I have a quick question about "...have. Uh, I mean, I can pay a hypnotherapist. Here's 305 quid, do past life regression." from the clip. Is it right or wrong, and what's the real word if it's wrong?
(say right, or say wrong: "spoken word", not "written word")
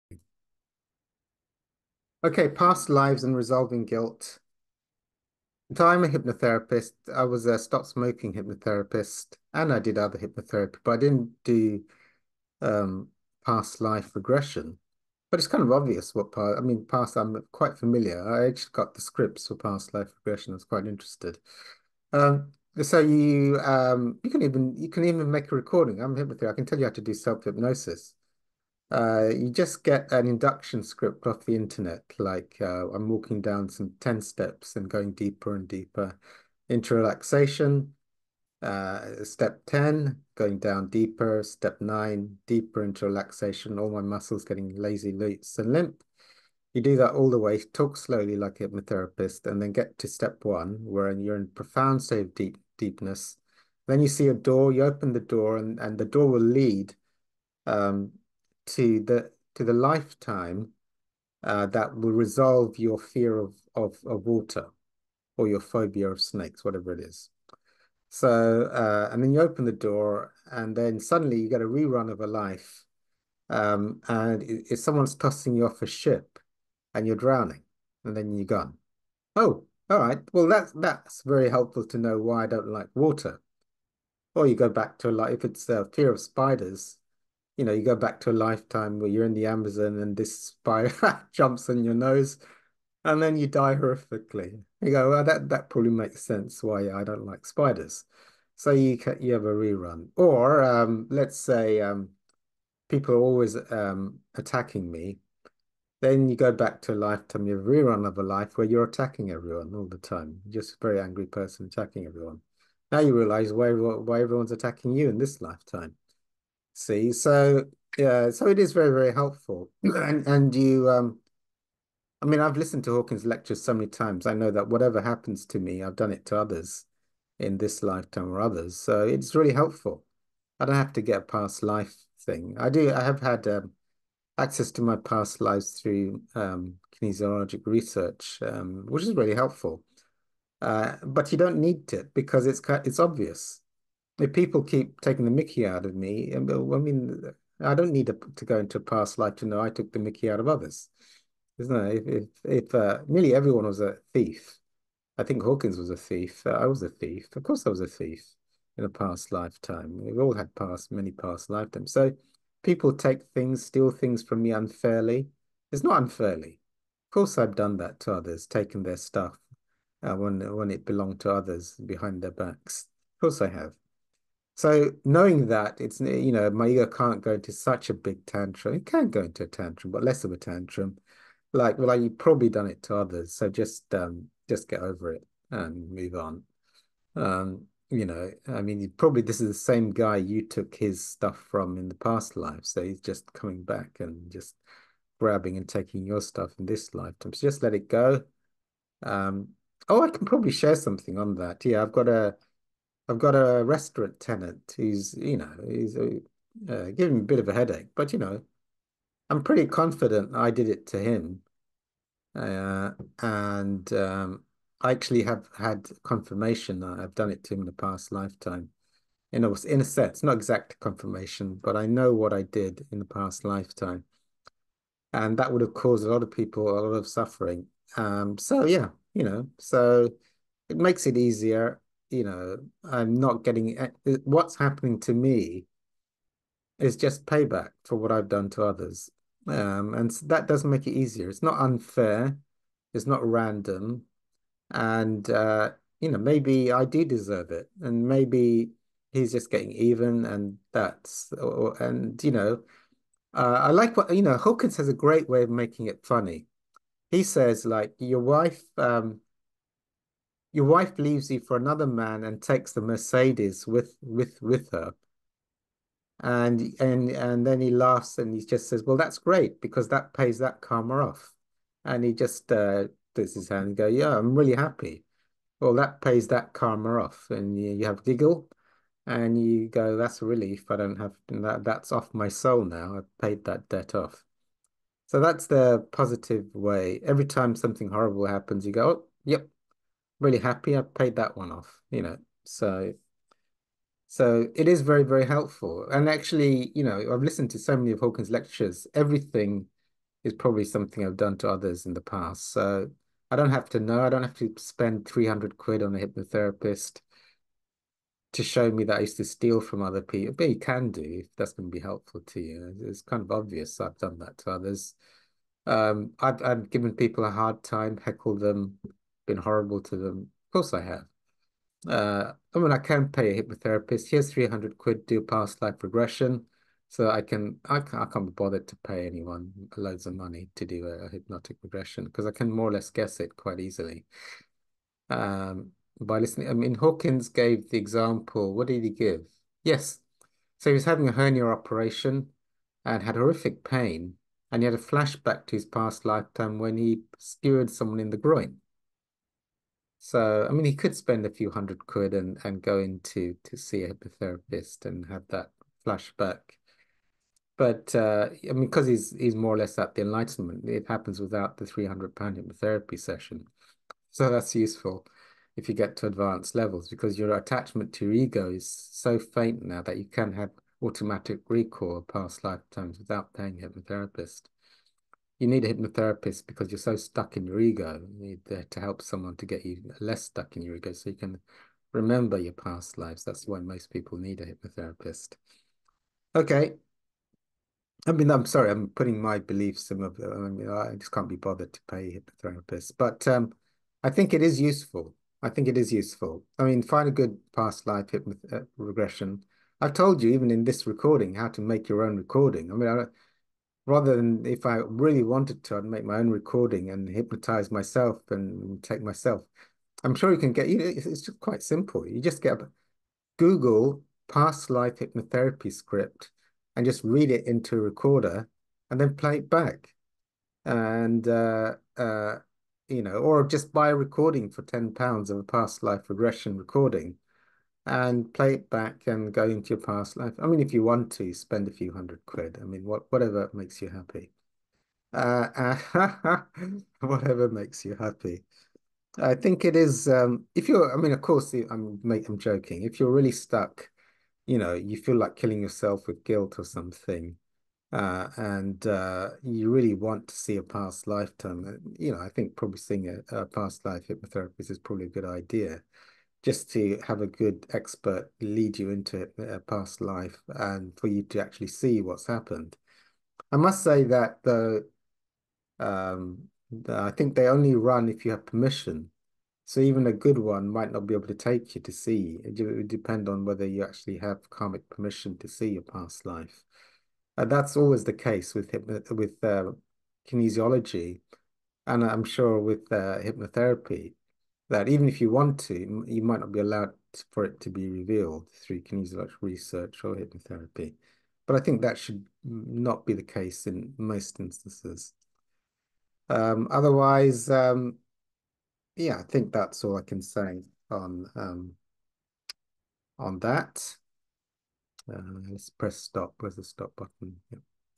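wrong: "300", not "305".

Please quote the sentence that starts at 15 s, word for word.
But it's kind of obvious what part.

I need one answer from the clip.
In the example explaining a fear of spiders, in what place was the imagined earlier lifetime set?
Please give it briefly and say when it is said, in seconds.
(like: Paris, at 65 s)
Amazon, at 89 s.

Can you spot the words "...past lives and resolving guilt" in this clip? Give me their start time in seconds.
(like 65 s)
2 s.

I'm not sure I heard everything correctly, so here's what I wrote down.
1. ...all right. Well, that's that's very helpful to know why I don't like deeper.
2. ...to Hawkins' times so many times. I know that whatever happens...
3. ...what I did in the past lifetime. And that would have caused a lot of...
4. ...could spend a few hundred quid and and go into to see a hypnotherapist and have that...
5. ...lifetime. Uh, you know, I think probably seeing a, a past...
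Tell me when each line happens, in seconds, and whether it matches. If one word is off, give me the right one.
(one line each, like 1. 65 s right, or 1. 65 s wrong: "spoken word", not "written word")
1. 79 s wrong: "water", not "deeper"
2. 122 s wrong: "lectures", not "times"
3. 222 s right
4. 350 s right
5. 451 s right.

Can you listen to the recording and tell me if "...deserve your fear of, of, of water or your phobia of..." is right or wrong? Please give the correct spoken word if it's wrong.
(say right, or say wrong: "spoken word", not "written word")
wrong: "resolve", not "deserve".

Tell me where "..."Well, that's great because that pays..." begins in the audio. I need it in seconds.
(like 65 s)
268 s.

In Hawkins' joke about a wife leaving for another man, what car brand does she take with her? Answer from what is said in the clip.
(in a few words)
Mercedes.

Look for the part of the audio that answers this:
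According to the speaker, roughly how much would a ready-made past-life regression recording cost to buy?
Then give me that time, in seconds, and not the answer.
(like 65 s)
424 s.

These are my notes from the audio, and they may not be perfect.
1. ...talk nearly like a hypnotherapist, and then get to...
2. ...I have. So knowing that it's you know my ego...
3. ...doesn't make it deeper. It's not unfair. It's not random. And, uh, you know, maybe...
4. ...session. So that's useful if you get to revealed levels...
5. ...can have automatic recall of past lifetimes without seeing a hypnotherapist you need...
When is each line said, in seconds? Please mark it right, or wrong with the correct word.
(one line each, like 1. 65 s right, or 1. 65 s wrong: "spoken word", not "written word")
1. 47 s wrong: "slowly", not "nearly"
2. 173 s right
3. 240 s wrong: "easier", not "deeper"
4. 362 s wrong: "advanced", not "revealed"
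5. 370 s wrong: "paying", not "seeing".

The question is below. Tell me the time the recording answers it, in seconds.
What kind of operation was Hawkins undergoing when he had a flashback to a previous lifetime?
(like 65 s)
341 s.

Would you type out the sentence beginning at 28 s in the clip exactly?
Uh, you just get an induction script off the internet.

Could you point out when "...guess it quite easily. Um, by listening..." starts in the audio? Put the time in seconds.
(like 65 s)
332 s.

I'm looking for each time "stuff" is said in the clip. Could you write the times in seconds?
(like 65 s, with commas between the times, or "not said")
168 s, 191 s, 196 s.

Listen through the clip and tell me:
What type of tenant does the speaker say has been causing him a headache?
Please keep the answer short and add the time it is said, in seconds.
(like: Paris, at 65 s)
restaurant, at 203 s.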